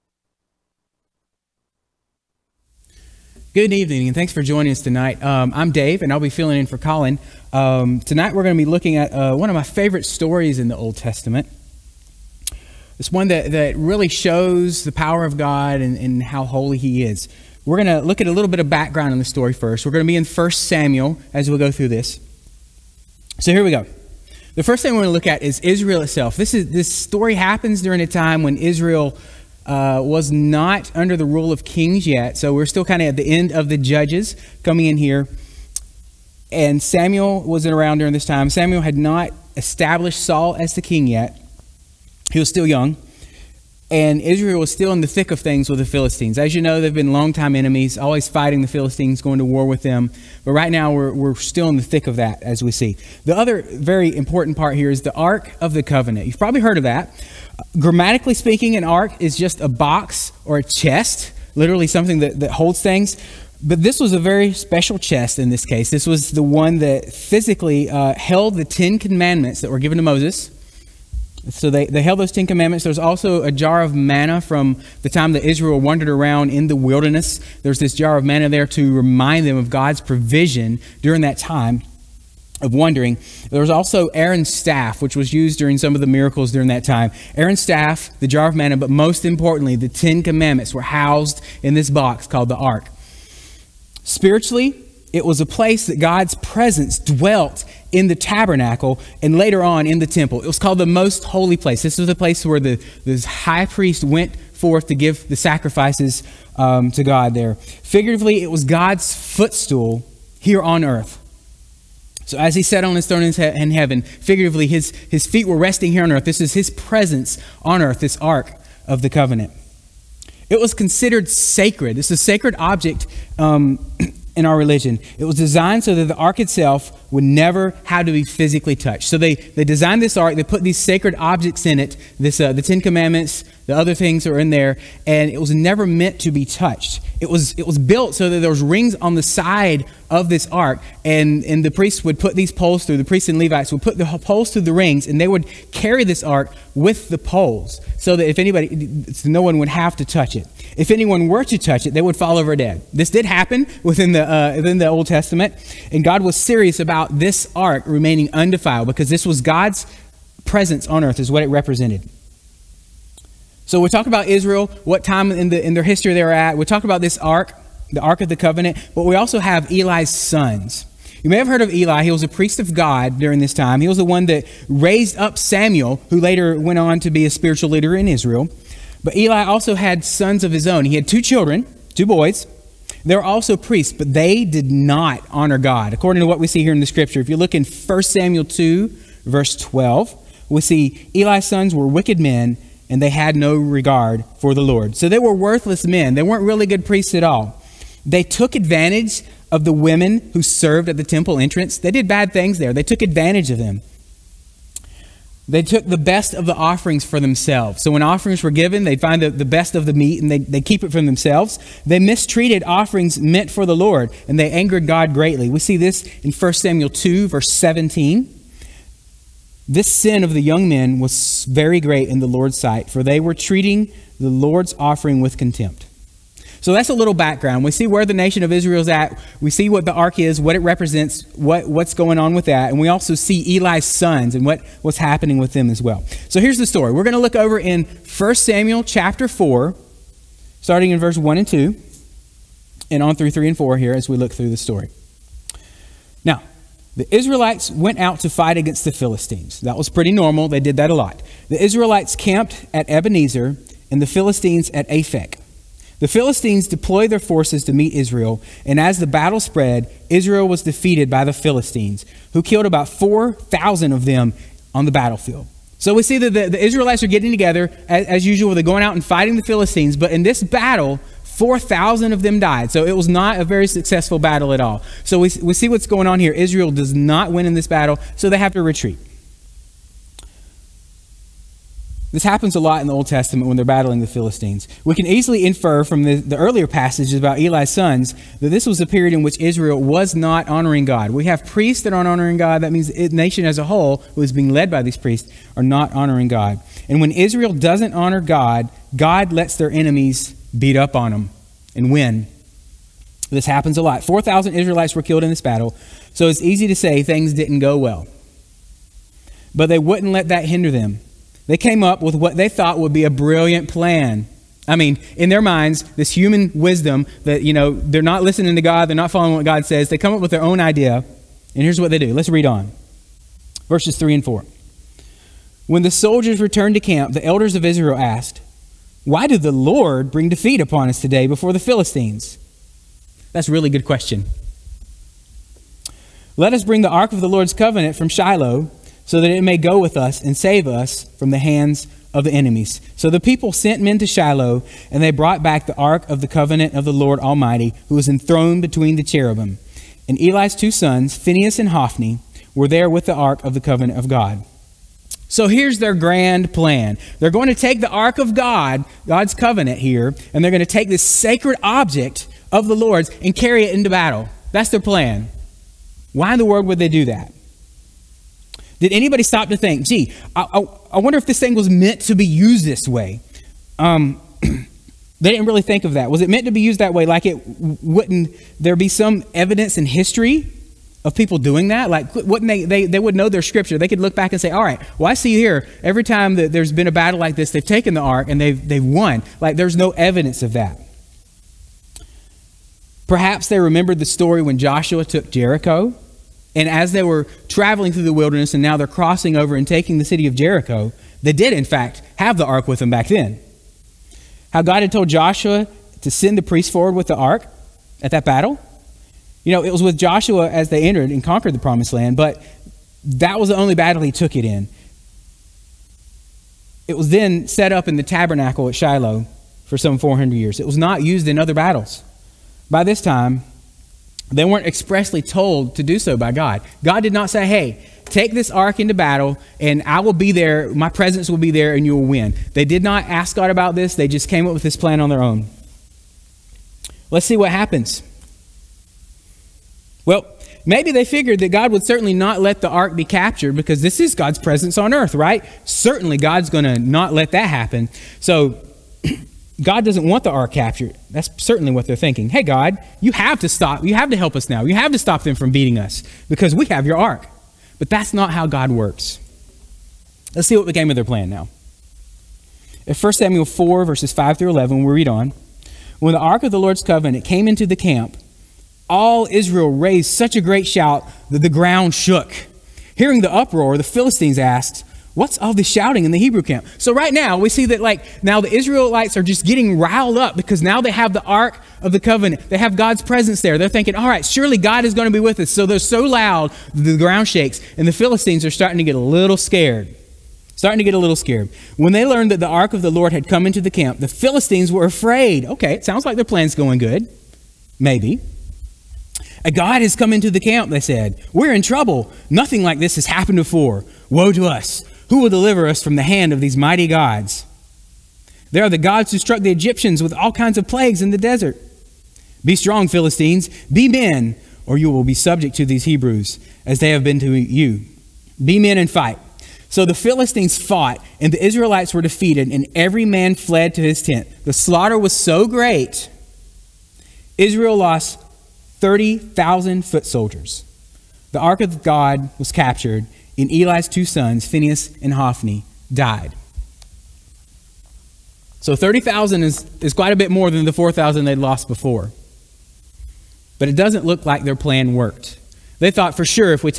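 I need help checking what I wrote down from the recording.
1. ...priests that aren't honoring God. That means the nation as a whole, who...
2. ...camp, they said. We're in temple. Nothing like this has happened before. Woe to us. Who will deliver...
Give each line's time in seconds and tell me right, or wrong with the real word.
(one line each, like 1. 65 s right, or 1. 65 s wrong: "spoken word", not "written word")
1. 291 s right
2. 500 s wrong: "trouble", not "temple".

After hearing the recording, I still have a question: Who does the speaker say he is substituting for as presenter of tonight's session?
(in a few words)
Colin.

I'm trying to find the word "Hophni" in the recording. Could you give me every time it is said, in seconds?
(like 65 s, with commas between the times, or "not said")
351 s, 535 s.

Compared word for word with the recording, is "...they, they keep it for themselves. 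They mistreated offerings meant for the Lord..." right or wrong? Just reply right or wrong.
right.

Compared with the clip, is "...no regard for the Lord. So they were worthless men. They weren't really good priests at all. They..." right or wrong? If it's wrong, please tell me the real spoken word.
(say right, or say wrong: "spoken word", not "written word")
right.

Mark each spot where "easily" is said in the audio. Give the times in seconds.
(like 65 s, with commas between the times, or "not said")
285 s.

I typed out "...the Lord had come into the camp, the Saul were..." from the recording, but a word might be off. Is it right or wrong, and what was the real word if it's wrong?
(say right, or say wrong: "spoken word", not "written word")
wrong: "Philistines", not "Saul".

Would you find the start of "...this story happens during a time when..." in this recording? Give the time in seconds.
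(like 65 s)
26 s.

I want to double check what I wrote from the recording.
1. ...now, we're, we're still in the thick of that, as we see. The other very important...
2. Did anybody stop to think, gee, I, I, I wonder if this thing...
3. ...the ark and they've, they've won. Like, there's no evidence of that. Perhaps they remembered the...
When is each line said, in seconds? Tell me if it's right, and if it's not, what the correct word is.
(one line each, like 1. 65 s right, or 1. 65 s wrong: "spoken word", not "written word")
1. 50 s right
2. 368 s right
3. 387 s right.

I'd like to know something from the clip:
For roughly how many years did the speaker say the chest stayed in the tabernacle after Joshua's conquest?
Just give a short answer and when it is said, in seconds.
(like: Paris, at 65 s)
400, at 419 s.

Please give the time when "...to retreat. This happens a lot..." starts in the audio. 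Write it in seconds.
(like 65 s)
278 s.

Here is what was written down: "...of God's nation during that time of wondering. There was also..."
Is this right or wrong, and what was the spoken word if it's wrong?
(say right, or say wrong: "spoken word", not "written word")
wrong: "provision", not "nation".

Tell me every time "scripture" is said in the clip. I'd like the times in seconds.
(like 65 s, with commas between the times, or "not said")
186 s, 383 s.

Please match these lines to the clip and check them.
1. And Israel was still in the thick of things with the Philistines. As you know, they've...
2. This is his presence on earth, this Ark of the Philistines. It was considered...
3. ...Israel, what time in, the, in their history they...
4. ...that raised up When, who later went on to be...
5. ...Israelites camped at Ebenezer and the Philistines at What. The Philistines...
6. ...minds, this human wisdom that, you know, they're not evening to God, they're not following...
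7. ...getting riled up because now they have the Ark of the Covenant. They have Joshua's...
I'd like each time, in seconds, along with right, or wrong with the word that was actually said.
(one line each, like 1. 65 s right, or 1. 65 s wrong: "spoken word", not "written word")
1. 43 s right
2. 116 s wrong: "Covenant", not "Philistines"
3. 164 s right
4. 174 s wrong: "Samuel", not "When"
5. 251 s wrong: "Aphek", not "What"
6. 315 s wrong: "listening", not "evening"
7. 479 s wrong: "God", not "Joshua".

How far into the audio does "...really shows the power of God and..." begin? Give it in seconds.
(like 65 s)
13 s.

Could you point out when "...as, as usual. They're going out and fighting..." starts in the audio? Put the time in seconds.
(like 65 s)
267 s.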